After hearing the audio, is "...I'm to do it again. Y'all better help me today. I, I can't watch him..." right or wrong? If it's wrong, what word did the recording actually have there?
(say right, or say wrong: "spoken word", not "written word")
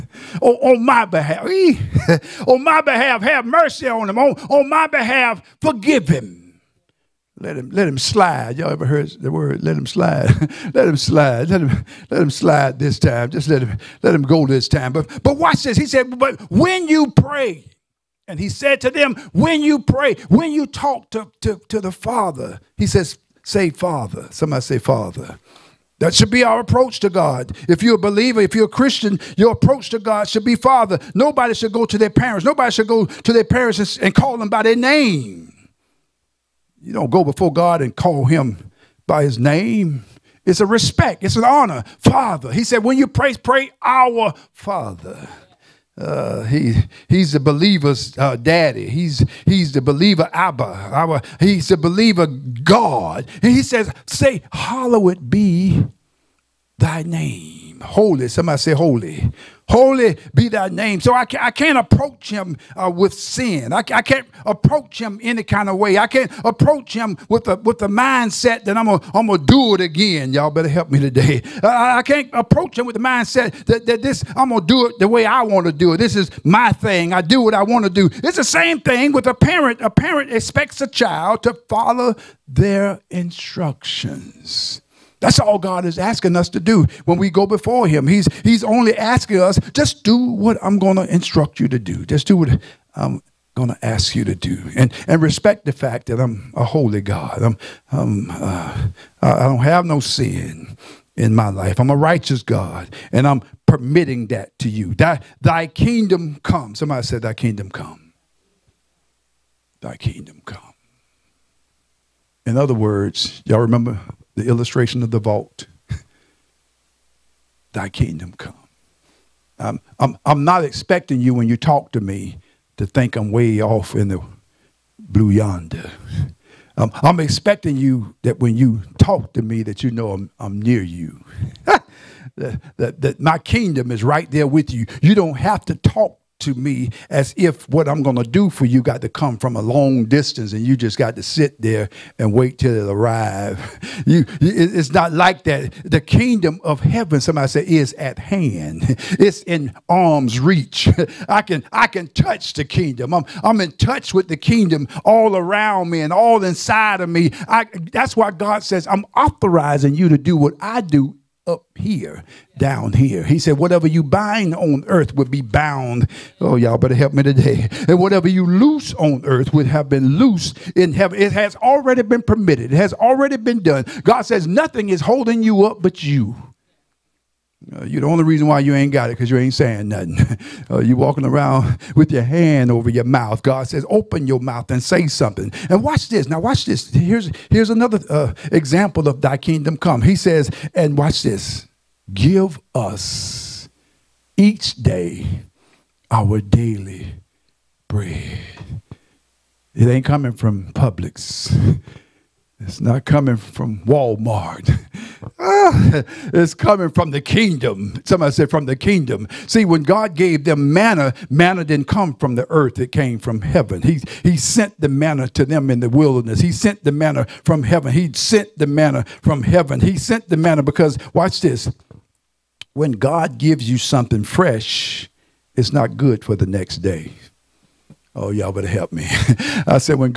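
wrong: "approach", not "watch".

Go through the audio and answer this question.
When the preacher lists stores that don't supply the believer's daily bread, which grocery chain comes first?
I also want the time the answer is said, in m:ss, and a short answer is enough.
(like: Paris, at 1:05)
Publix, at 3:20.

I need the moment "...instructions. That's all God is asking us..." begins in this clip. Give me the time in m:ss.
1:23.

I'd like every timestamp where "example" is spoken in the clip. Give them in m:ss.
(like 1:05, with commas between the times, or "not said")
3:08.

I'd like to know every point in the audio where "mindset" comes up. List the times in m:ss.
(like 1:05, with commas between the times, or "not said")
1:07, 1:13.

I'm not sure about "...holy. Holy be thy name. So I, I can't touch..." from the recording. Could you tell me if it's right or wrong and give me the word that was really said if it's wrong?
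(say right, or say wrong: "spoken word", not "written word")
wrong: "approach", not "touch".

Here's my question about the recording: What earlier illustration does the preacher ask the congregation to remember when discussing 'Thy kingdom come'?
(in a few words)
the vault.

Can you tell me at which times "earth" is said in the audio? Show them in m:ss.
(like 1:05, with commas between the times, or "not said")
2:44, 2:49, 3:32.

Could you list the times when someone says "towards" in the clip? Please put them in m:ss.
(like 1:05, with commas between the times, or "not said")
not said.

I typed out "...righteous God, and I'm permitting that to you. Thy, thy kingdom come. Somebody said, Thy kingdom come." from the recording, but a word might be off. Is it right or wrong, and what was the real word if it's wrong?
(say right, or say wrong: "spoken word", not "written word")
right.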